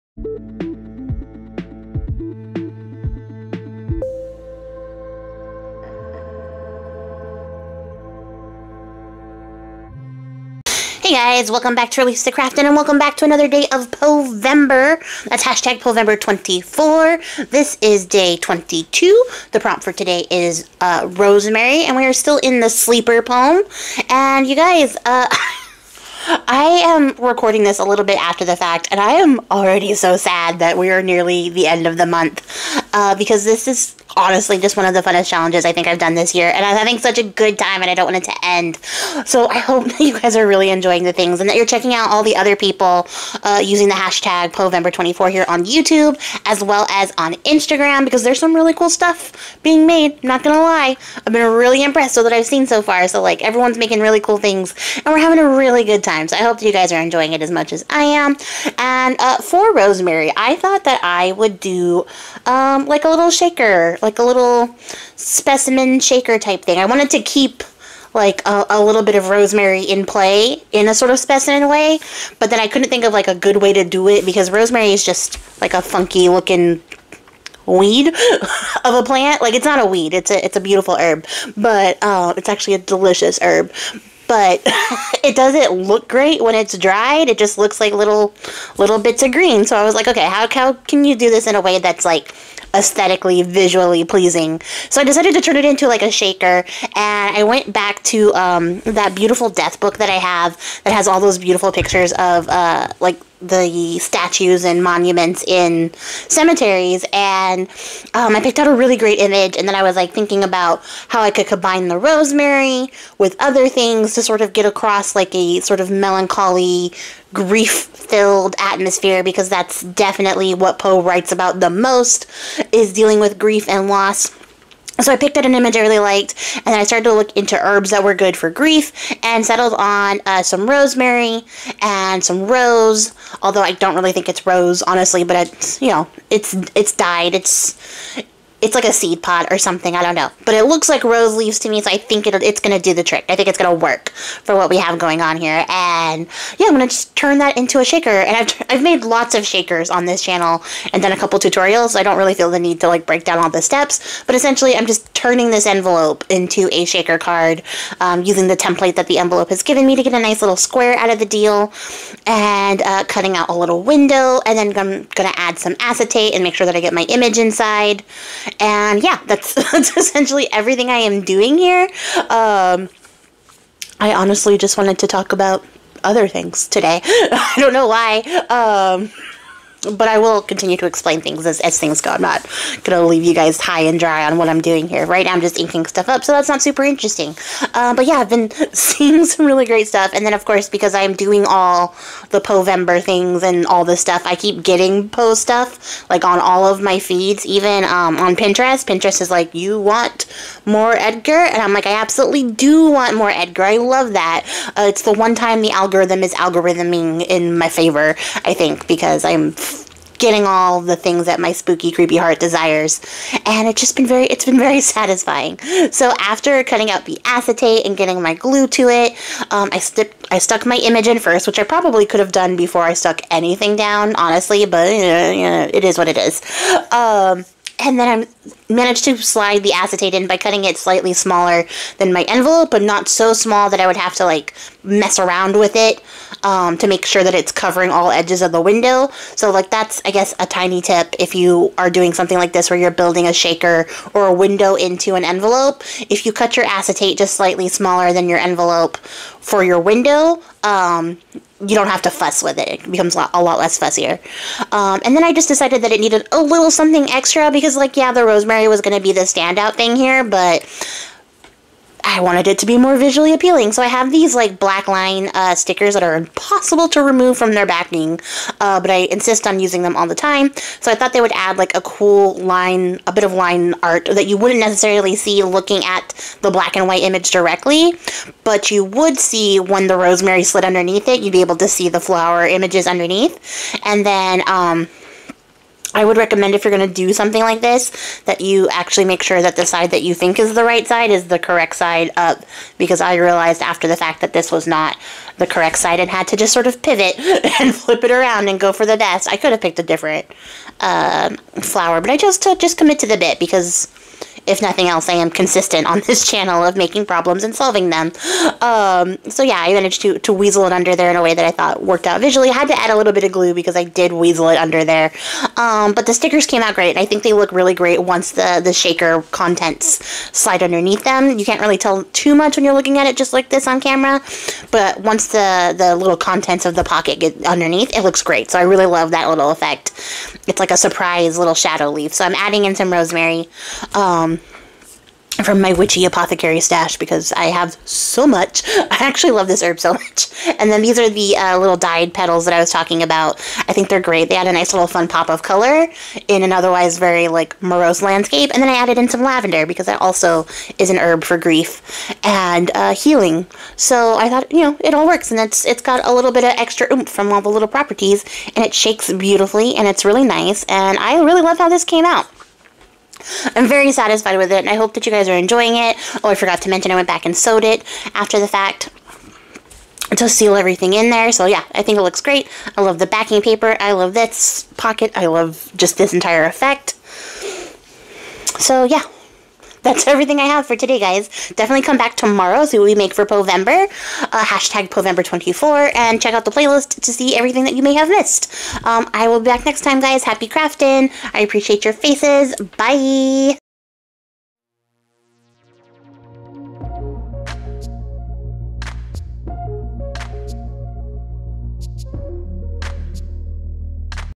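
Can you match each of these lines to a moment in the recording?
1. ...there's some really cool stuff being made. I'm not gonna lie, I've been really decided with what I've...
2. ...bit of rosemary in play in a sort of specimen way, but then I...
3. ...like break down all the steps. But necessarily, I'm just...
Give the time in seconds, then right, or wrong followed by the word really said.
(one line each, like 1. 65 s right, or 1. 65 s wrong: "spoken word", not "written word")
1. 48 s wrong: "impressed", not "decided"
2. 69 s right
3. 152 s wrong: "essentially", not "necessarily".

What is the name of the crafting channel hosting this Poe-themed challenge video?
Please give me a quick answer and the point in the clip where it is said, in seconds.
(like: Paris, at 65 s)
Release the Craftin, at 12 s.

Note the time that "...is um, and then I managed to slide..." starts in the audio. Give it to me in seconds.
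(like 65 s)
226 s.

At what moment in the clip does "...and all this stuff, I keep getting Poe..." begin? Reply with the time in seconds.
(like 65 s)
193 s.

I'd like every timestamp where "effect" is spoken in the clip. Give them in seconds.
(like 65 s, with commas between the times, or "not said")
329 s, 376 s.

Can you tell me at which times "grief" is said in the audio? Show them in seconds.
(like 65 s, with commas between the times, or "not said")
117 s, 123 s, 128 s, 351 s.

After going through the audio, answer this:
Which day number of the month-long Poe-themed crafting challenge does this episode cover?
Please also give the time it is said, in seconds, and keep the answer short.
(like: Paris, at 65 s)
22, at 18 s.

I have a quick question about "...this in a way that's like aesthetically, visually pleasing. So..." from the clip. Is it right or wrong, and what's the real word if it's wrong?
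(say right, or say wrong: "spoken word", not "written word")
right.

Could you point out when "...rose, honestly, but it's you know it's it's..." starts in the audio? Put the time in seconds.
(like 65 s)
134 s.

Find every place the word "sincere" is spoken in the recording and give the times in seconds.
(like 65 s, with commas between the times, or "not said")
not said.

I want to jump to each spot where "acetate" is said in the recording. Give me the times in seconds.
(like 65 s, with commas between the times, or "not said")
165 s, 217 s, 229 s, 246 s.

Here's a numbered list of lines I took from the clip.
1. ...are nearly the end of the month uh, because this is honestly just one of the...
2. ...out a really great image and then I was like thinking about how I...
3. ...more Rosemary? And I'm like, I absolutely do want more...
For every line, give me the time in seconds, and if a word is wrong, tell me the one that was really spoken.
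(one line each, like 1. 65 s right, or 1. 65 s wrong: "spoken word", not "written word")
1. 30 s right
2. 108 s right
3. 200 s wrong: "Edgar", not "Rosemary".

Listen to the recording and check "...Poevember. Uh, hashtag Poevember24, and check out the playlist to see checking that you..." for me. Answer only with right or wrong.
wrong.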